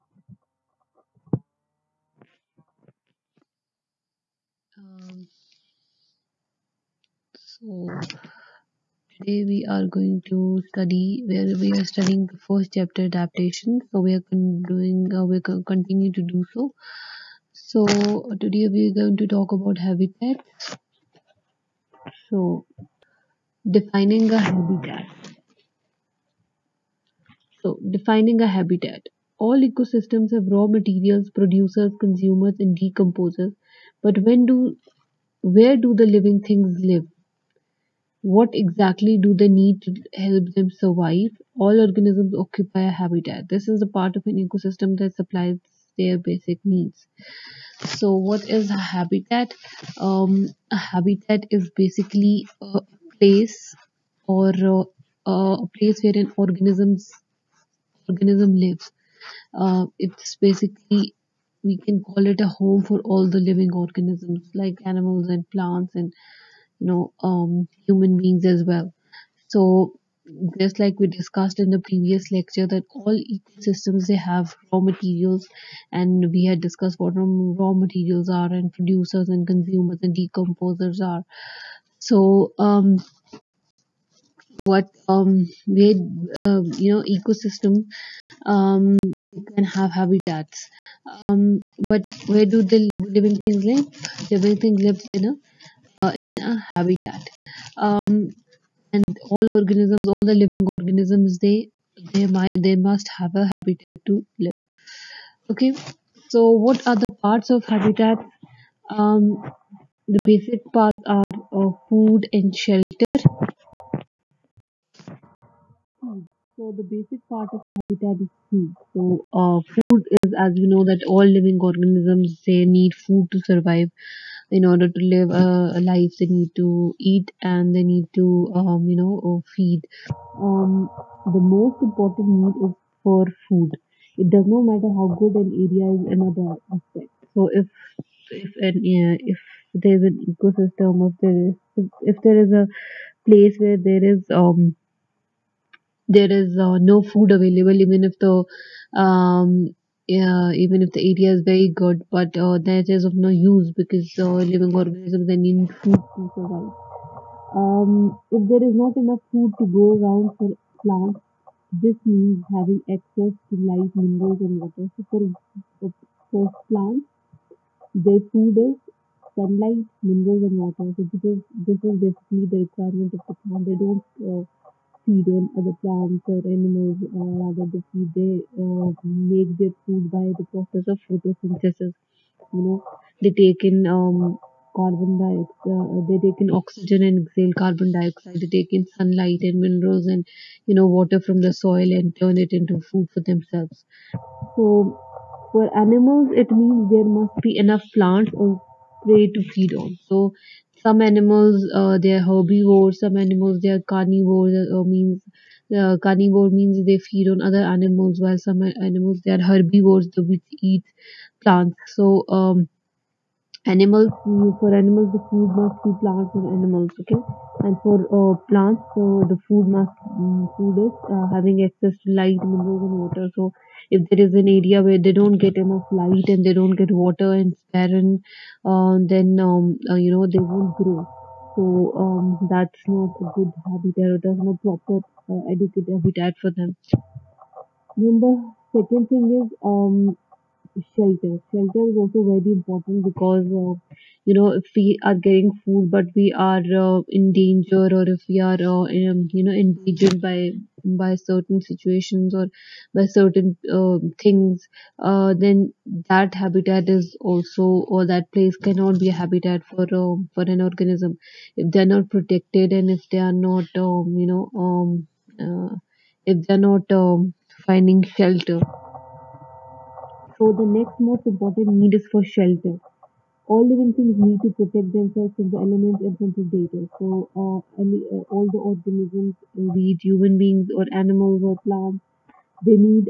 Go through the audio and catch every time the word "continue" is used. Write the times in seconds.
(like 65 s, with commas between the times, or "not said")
15 s.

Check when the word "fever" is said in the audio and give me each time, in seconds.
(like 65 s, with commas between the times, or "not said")
not said.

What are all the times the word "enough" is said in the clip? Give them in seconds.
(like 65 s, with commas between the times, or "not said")
158 s, 197 s, 225 s.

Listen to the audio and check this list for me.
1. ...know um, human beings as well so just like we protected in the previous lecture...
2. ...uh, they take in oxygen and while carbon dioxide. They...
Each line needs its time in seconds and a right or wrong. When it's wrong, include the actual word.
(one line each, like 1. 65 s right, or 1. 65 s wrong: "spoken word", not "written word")
1. 66 s wrong: "discussed", not "protected"
2. 185 s wrong: "exhale", not "while".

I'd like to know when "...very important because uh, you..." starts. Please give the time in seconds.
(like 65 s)
242 s.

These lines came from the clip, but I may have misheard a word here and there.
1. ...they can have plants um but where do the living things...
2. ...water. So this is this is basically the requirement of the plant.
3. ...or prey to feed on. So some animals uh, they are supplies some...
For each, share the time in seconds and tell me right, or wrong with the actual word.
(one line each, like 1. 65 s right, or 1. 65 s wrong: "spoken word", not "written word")
1. 89 s wrong: "habitats", not "plants"
2. 170 s right
3. 198 s wrong: "herbivores", not "supplies".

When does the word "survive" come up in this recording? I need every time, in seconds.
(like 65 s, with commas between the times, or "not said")
40 s, 123 s, 156 s.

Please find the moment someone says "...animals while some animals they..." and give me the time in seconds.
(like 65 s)
207 s.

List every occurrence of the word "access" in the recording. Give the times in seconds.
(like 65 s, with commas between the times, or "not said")
162 s, 221 s.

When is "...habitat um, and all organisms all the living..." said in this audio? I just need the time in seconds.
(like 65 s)
96 s.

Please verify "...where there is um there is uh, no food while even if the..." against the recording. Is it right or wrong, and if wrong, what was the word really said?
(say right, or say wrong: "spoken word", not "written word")
wrong: "available", not "while".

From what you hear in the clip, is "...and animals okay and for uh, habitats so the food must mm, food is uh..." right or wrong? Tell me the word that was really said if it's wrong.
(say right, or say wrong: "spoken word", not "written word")
wrong: "plants", not "habitats".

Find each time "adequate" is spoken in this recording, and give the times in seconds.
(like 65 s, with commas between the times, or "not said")
235 s.